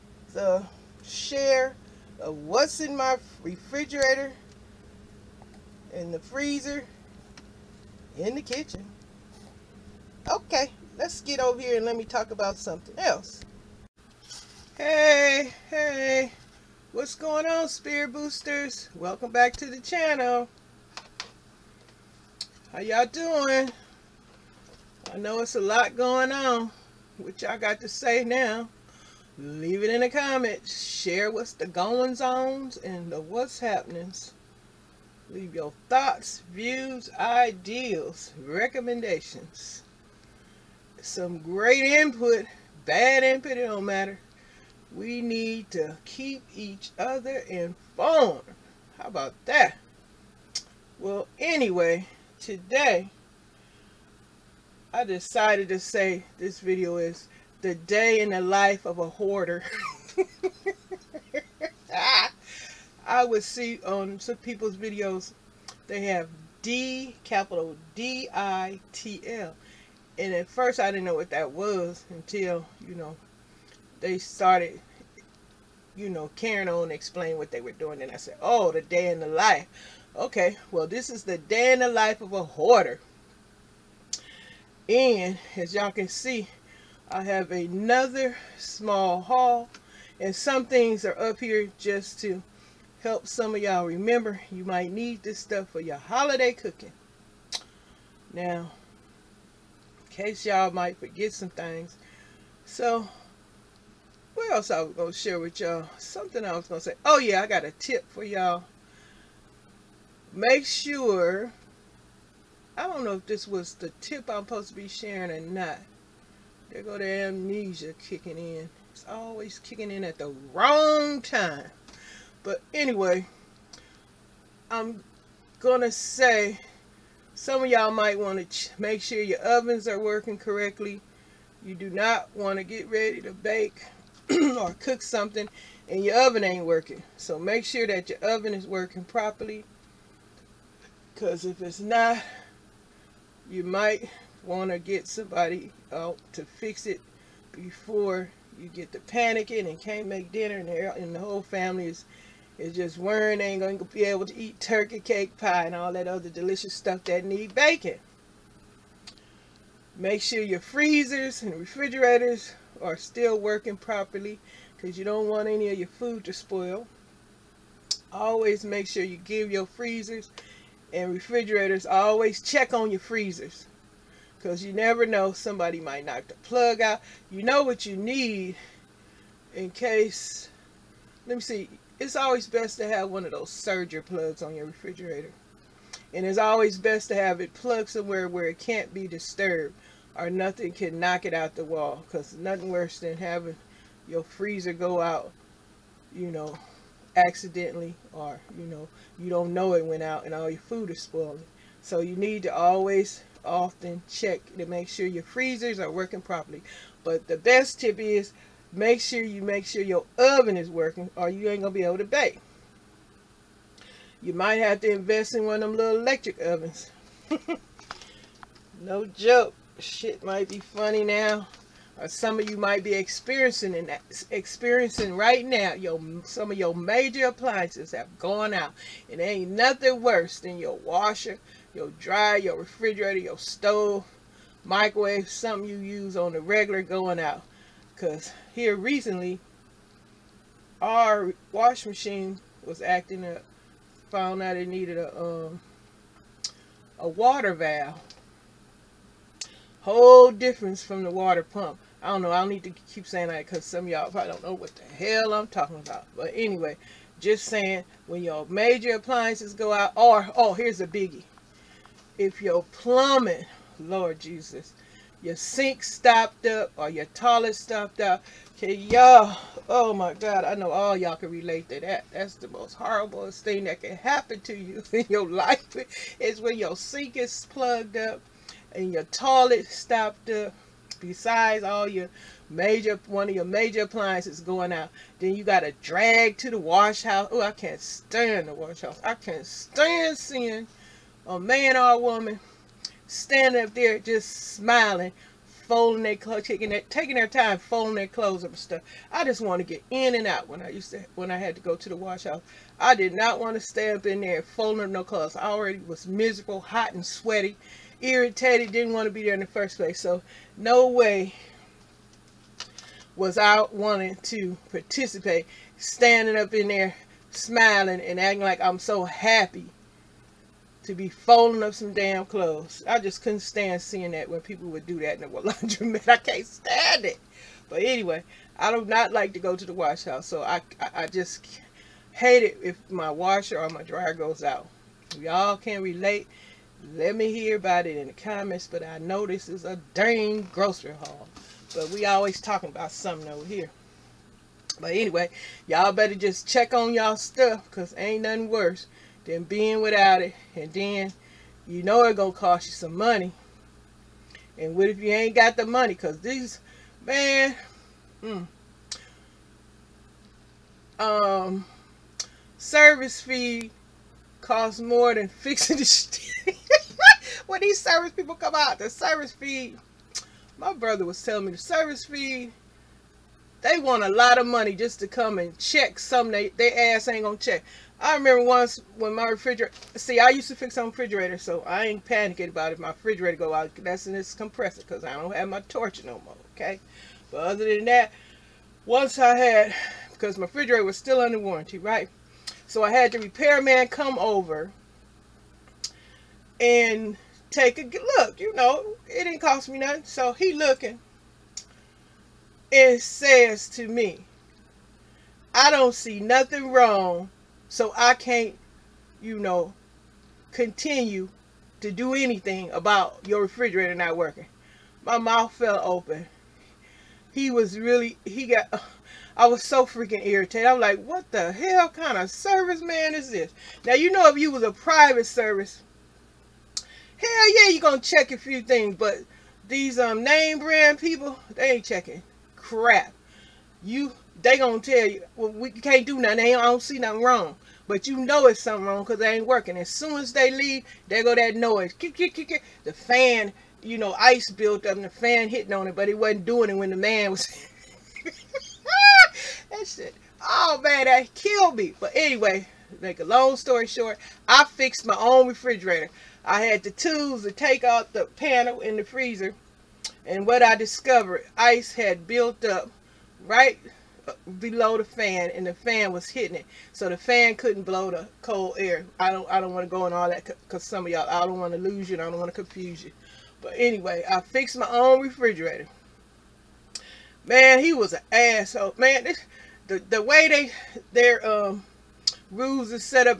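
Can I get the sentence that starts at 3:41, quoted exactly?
Or some of you might be experiencing and experiencing right now.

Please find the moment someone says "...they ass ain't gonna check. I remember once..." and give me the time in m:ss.
6:16.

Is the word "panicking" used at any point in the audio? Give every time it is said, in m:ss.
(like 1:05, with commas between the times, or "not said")
2:28, 6:22.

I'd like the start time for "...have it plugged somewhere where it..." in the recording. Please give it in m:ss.
3:07.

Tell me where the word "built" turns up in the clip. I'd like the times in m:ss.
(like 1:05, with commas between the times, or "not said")
7:24, 7:42.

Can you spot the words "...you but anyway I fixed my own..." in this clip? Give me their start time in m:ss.
7:53.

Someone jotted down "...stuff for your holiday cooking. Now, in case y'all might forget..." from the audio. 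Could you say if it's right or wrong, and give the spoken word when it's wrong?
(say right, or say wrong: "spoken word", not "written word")
right.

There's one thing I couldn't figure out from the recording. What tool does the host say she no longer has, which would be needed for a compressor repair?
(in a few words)
torch.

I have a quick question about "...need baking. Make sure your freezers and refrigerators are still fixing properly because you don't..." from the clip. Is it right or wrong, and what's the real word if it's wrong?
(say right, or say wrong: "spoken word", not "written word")
wrong: "working", not "fixing".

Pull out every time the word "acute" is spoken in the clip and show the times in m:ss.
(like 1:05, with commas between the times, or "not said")
not said.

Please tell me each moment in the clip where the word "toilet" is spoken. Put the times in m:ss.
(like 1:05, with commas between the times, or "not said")
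4:27, 4:39.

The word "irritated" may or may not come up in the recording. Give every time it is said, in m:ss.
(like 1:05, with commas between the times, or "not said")
5:08, 7:00.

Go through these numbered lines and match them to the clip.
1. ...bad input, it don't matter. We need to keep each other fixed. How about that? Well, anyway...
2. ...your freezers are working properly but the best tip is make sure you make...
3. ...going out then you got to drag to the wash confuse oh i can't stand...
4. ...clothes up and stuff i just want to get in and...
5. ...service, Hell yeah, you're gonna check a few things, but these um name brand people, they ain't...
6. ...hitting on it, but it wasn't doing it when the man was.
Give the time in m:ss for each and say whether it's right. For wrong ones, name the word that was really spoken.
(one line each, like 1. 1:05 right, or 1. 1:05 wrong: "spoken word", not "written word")
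1. 0:42 wrong: "informed", not "fixed"
2. 3:25 right
3. 4:44 wrong: "house", not "confuse"
4. 4:58 right
5. 7:05 right
6. 7:25 right.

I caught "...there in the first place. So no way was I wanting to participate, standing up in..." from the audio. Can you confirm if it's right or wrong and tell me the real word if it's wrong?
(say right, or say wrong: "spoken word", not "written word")
right.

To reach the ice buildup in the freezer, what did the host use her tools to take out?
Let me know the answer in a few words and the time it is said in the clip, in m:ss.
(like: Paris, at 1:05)
the panel, at 7:38.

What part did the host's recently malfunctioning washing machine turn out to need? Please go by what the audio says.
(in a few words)
water valve.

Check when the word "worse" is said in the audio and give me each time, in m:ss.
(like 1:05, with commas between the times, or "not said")
3:12, 3:50, 5:48.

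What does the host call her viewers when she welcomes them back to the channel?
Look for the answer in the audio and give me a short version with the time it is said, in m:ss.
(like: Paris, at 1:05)
Spirit Boosters, at 0:17.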